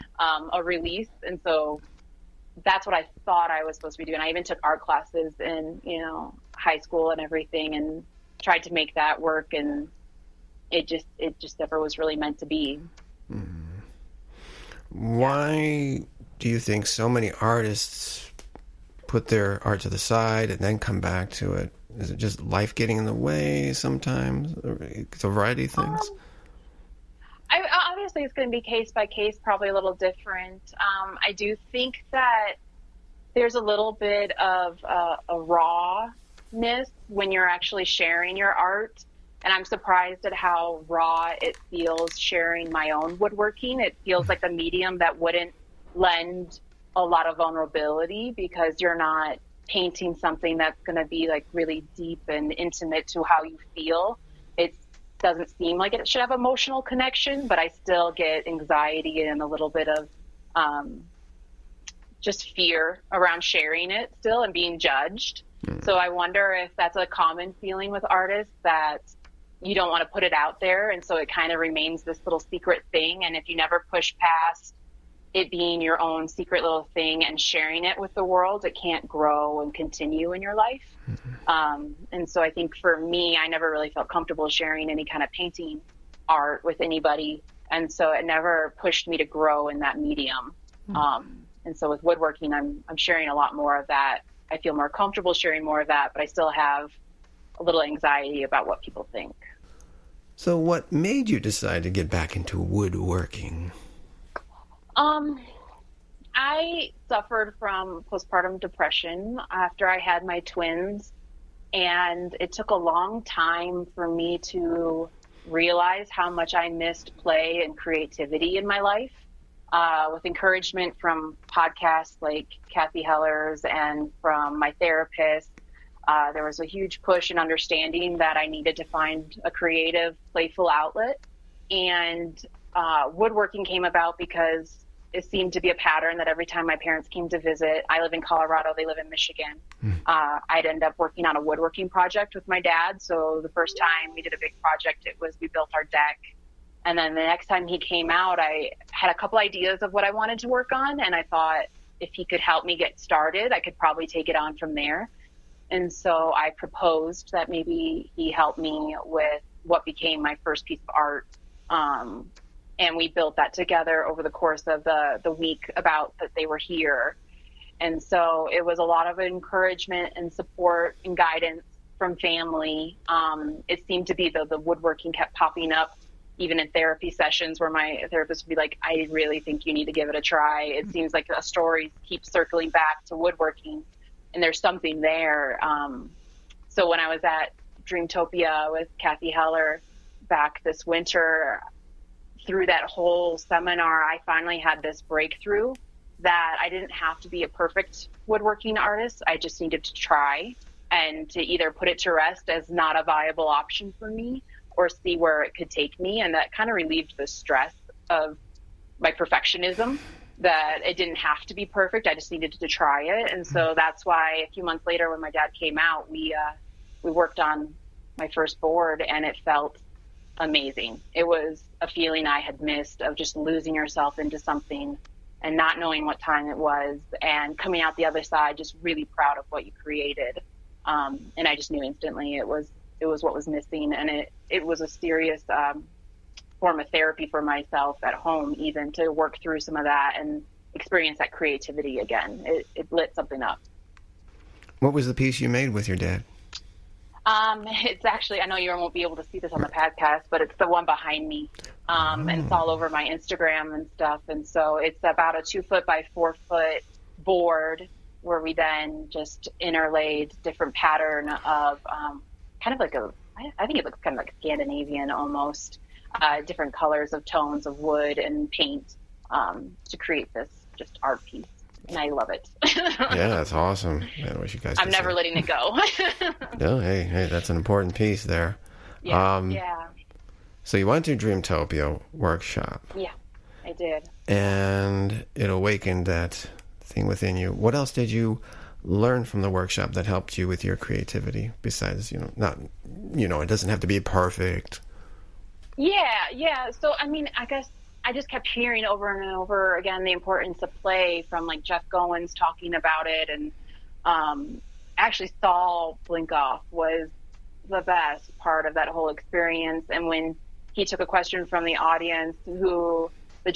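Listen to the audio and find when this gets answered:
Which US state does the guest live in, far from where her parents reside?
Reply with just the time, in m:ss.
2:18.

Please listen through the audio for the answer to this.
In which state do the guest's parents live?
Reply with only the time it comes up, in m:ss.
2:19.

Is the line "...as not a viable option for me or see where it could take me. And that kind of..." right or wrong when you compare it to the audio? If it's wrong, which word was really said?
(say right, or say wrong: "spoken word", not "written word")
right.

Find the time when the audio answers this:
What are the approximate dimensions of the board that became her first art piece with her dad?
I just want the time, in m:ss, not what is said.
4:15.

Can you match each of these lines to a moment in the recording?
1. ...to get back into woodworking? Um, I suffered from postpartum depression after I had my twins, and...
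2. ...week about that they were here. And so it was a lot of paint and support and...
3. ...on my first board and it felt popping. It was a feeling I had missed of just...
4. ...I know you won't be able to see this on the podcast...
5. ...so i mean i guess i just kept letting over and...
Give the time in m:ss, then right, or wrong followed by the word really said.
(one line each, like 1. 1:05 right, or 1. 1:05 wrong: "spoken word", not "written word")
1. 1:41 right
2. 2:45 wrong: "encouragement", not "paint"
3. 3:37 wrong: "amazing", not "popping"
4. 4:08 right
5. 4:56 wrong: "hearing", not "letting".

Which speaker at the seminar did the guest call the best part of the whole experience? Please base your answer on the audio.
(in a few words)
Saul Blinkoff.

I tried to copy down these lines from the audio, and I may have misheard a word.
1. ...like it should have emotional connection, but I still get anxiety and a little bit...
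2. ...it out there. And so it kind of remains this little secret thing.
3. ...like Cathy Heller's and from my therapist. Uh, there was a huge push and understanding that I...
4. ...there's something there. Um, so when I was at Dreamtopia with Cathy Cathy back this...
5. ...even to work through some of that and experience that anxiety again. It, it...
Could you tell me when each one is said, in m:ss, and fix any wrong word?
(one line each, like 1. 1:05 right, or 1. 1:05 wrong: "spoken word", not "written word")
1. 0:55 right
2. 1:10 right
3. 2:02 right
4. 3:04 wrong: "Heller", not "Cathy"
5. 3:58 wrong: "creativity", not "anxiety".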